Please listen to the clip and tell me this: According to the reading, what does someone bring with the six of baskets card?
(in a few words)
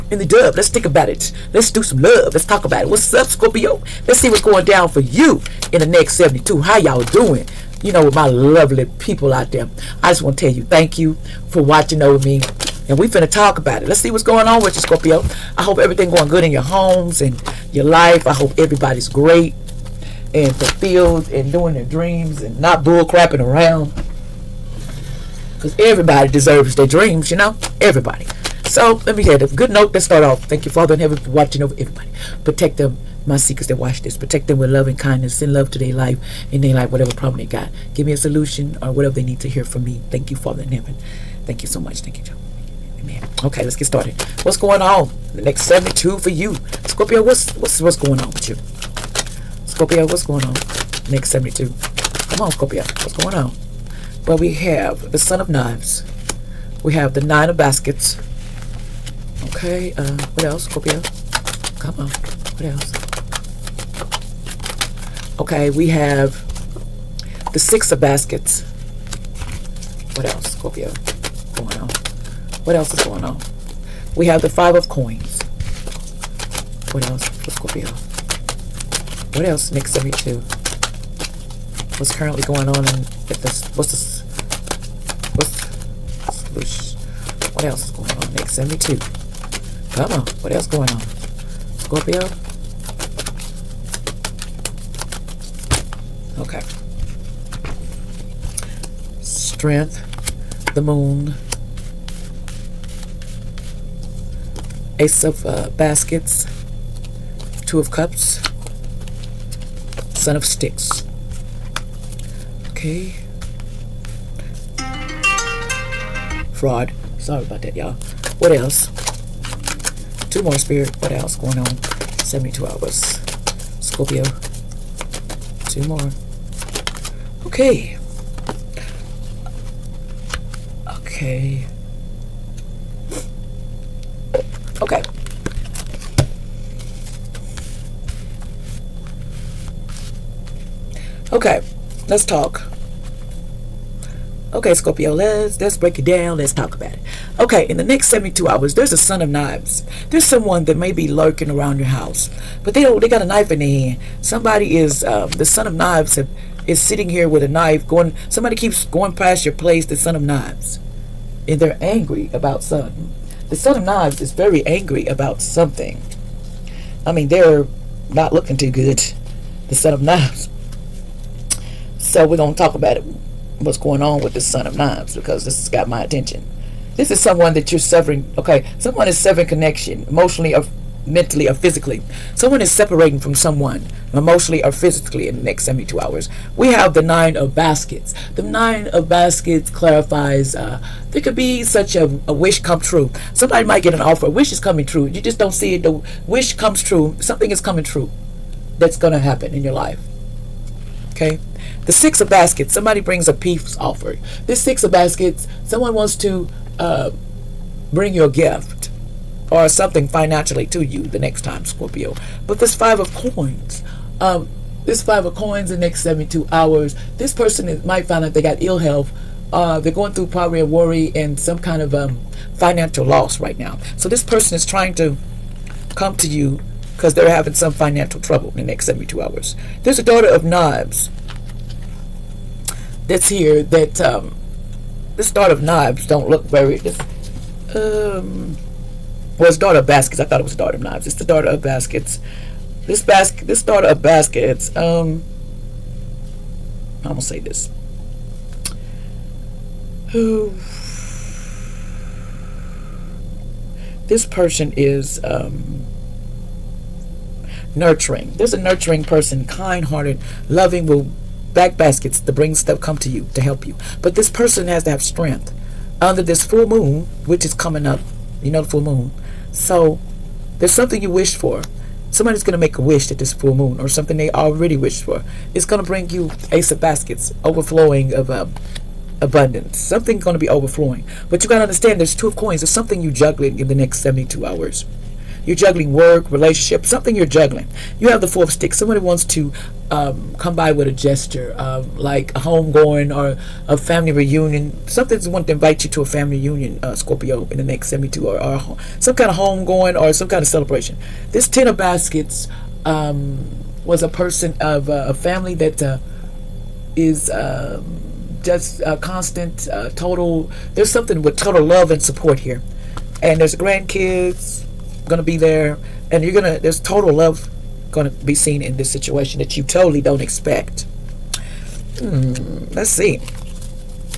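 A peace offering.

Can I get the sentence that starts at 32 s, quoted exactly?
Protect them, my seekers that watch this.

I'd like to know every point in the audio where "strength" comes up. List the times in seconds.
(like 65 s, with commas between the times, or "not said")
99 s, 265 s.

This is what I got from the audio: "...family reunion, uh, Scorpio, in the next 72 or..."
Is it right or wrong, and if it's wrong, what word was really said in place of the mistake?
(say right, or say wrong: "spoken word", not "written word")
right.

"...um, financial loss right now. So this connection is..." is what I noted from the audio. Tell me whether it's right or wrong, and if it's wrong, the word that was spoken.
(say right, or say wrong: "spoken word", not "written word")
wrong: "person", not "connection".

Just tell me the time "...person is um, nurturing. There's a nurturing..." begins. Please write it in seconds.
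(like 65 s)
254 s.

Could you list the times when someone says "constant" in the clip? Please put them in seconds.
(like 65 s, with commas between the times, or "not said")
308 s.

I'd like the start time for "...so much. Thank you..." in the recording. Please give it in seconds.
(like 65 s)
41 s.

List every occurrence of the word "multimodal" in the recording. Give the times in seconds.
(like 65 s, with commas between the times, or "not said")
not said.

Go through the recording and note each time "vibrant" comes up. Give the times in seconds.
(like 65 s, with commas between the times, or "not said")
not said.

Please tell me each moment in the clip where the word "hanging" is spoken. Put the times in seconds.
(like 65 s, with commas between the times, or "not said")
not said.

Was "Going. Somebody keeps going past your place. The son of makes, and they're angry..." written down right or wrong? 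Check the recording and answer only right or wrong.
wrong.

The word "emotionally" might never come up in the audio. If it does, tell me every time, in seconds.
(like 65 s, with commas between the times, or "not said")
180 s, 184 s.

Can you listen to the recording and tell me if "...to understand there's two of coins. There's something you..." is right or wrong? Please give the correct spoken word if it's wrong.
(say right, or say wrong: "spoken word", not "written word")
right.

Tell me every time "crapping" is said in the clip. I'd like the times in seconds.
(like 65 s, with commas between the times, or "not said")
23 s.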